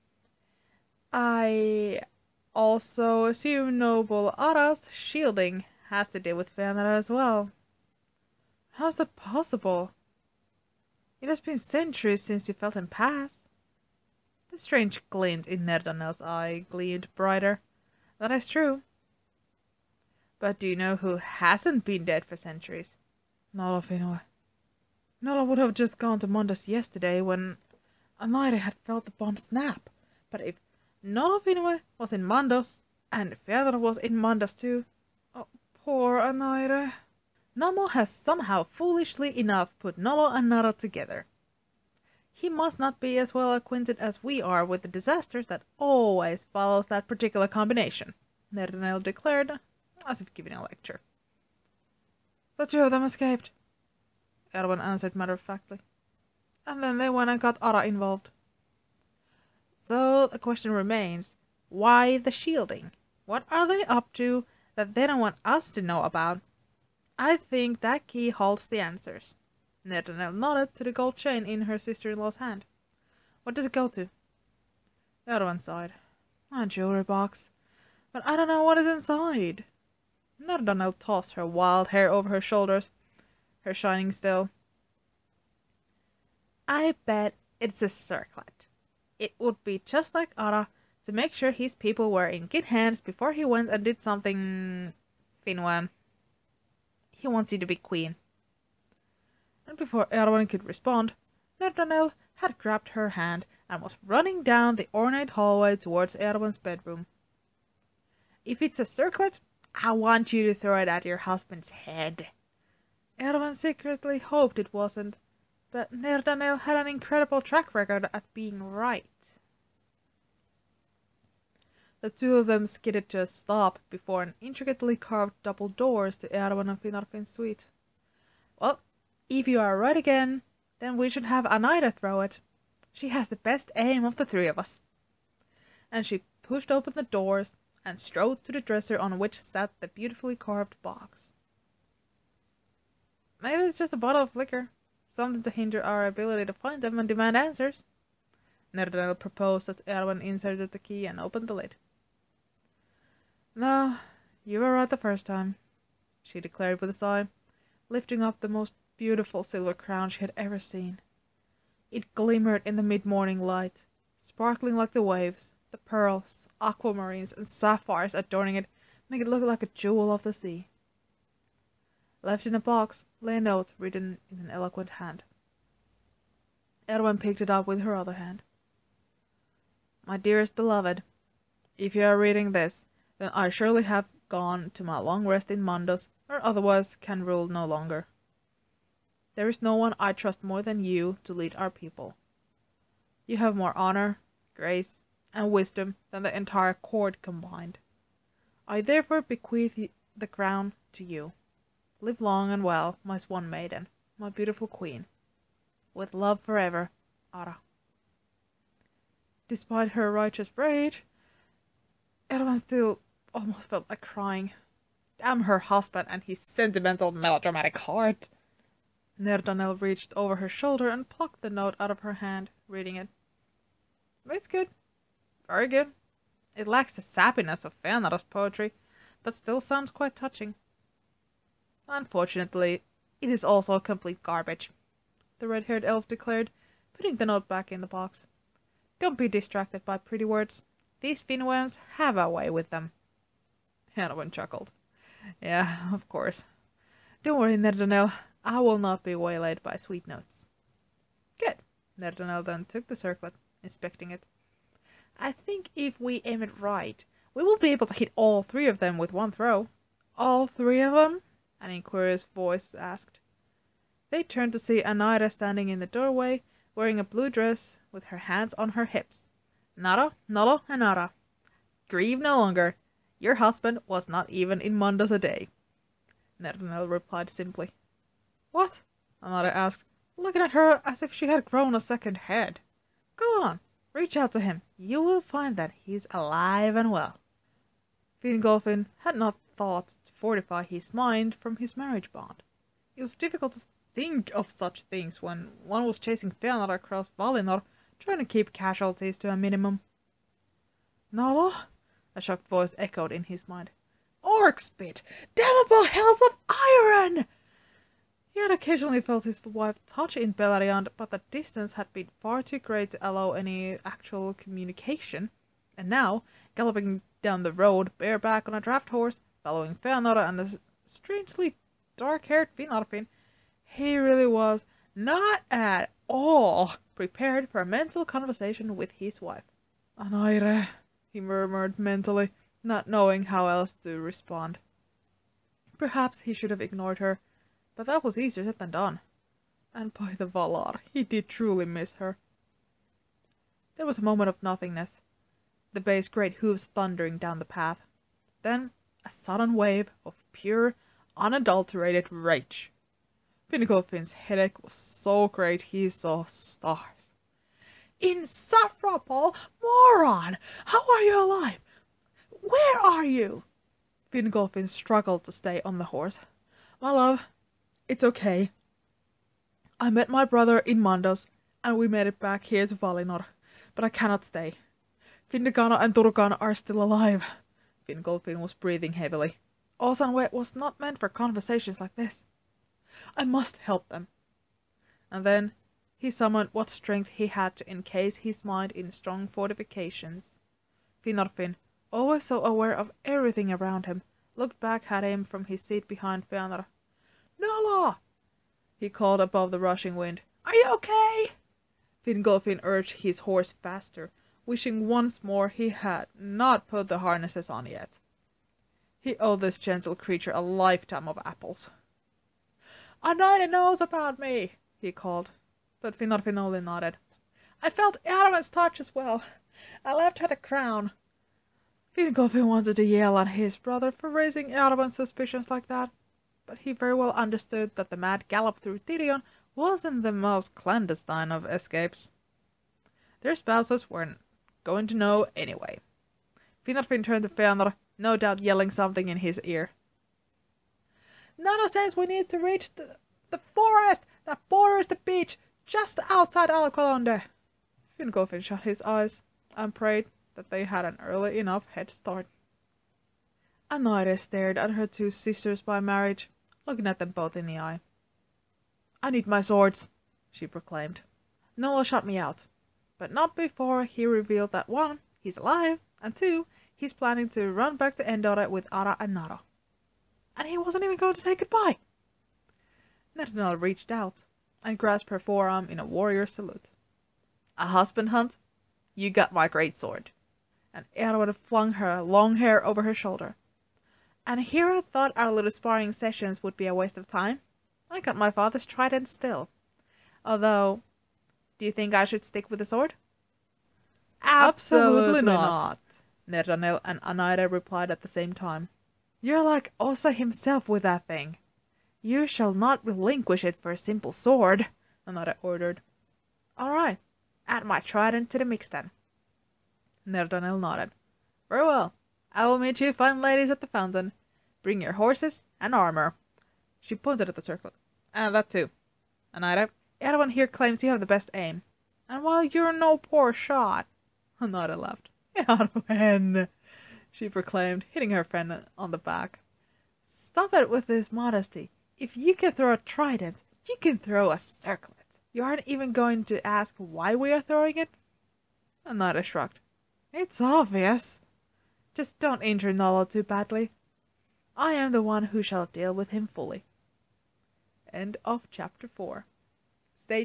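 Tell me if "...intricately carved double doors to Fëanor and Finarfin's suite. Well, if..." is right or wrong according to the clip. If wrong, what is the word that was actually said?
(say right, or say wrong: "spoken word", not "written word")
wrong: "Eärwen", not "Fëanor".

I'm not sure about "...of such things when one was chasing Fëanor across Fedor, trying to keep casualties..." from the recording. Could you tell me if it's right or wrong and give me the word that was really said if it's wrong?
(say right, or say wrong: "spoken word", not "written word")
wrong: "Valinor", not "Fedor".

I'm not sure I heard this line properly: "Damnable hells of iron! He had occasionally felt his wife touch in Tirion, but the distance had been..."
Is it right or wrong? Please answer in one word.
wrong.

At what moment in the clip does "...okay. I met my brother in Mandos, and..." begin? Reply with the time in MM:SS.
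06:08.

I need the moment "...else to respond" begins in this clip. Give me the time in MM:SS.
05:33.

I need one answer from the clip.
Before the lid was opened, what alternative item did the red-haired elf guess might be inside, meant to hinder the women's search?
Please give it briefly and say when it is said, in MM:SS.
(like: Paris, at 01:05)
A bottle of liquor, at 02:23.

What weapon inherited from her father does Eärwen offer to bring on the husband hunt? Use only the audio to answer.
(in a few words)
A trident.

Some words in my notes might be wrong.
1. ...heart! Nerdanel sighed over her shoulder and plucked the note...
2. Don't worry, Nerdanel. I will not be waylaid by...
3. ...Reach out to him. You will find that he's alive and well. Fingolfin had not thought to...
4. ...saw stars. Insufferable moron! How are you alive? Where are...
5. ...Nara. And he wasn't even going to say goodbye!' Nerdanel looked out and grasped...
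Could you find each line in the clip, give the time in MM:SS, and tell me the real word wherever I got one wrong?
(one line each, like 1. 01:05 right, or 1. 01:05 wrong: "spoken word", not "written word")
1. 03:37 wrong: "reached", not "sighed"
2. 04:07 right
3. 04:43 right
4. 05:55 right
5. 07:49 wrong: "reached", not "looked".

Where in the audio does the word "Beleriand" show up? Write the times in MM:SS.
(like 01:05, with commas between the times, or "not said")
05:10.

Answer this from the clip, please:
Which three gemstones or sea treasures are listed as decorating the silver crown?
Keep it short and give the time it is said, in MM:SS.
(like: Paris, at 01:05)
Pearls, aquamarines and sapphires, at 02:45.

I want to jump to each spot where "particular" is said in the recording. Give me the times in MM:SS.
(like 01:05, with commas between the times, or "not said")
00:47.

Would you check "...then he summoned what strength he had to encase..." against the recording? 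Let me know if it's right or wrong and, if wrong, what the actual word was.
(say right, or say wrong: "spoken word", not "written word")
right.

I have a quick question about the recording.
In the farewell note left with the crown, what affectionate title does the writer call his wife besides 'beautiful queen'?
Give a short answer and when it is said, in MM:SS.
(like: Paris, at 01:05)
Swan maiden, at 03:23.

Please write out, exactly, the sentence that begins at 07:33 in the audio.
Anairë stared at her two sisters by marriage looking at them both in the eye.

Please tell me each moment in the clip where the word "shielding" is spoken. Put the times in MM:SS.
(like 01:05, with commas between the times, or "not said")
00:04, 01:02.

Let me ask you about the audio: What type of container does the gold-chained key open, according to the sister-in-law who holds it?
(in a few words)
A jewelry box.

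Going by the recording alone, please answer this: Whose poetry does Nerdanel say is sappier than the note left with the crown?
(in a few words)
Fëanáro's.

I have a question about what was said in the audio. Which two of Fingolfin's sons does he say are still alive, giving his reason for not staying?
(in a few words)
Findekáno and Turukáno.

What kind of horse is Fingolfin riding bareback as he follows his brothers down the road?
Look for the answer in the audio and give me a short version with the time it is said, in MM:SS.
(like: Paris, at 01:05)
A draft horse, at 05:18.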